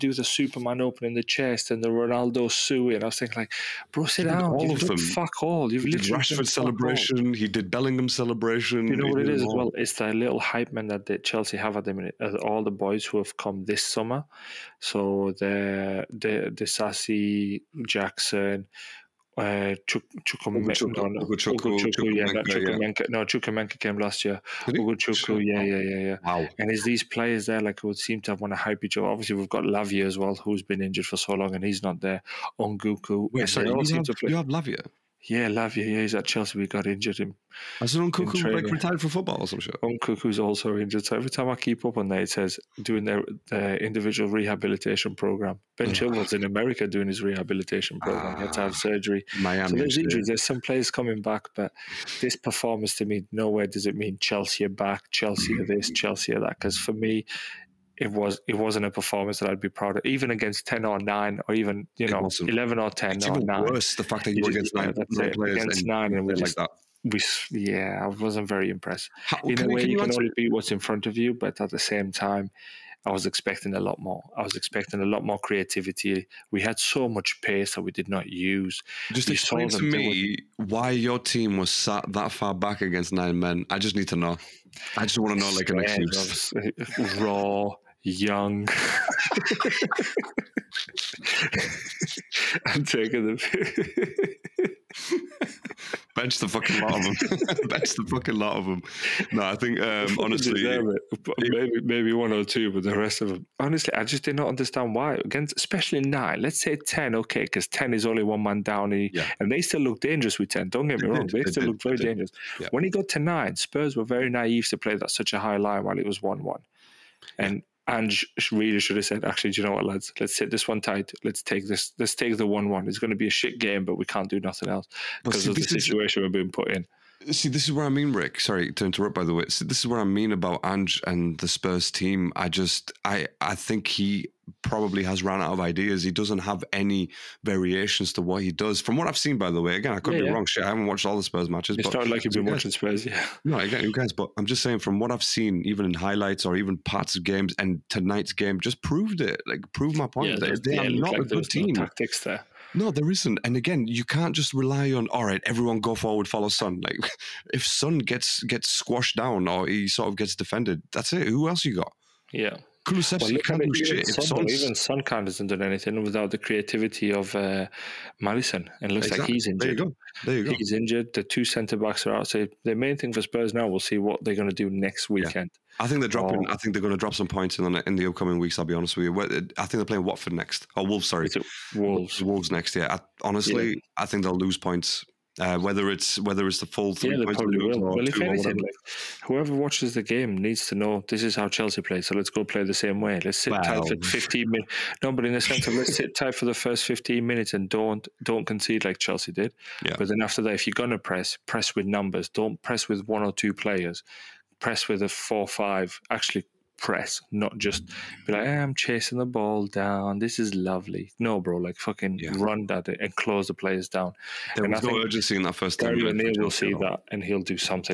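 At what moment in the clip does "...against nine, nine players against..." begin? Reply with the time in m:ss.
1:04.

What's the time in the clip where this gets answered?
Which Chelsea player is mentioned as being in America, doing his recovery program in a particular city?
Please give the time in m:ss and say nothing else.
0:45.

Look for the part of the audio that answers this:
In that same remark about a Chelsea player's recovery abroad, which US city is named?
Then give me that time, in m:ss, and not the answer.
0:49.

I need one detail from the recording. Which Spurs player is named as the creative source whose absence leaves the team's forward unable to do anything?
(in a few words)
Maddison.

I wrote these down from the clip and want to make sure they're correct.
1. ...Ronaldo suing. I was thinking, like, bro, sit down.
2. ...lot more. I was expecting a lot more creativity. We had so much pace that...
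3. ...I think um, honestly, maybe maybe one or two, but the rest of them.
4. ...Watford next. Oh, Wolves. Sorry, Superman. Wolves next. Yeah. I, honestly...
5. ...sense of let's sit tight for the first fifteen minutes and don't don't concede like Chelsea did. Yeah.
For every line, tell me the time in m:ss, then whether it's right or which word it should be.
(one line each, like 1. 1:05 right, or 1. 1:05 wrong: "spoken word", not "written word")
1. 0:01 right
2. 1:13 right
3. 1:39 right
4. 3:00 wrong: "Wolves", not "Superman"
5. 3:15 right.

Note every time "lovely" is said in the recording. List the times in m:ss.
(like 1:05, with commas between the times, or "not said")
3:30.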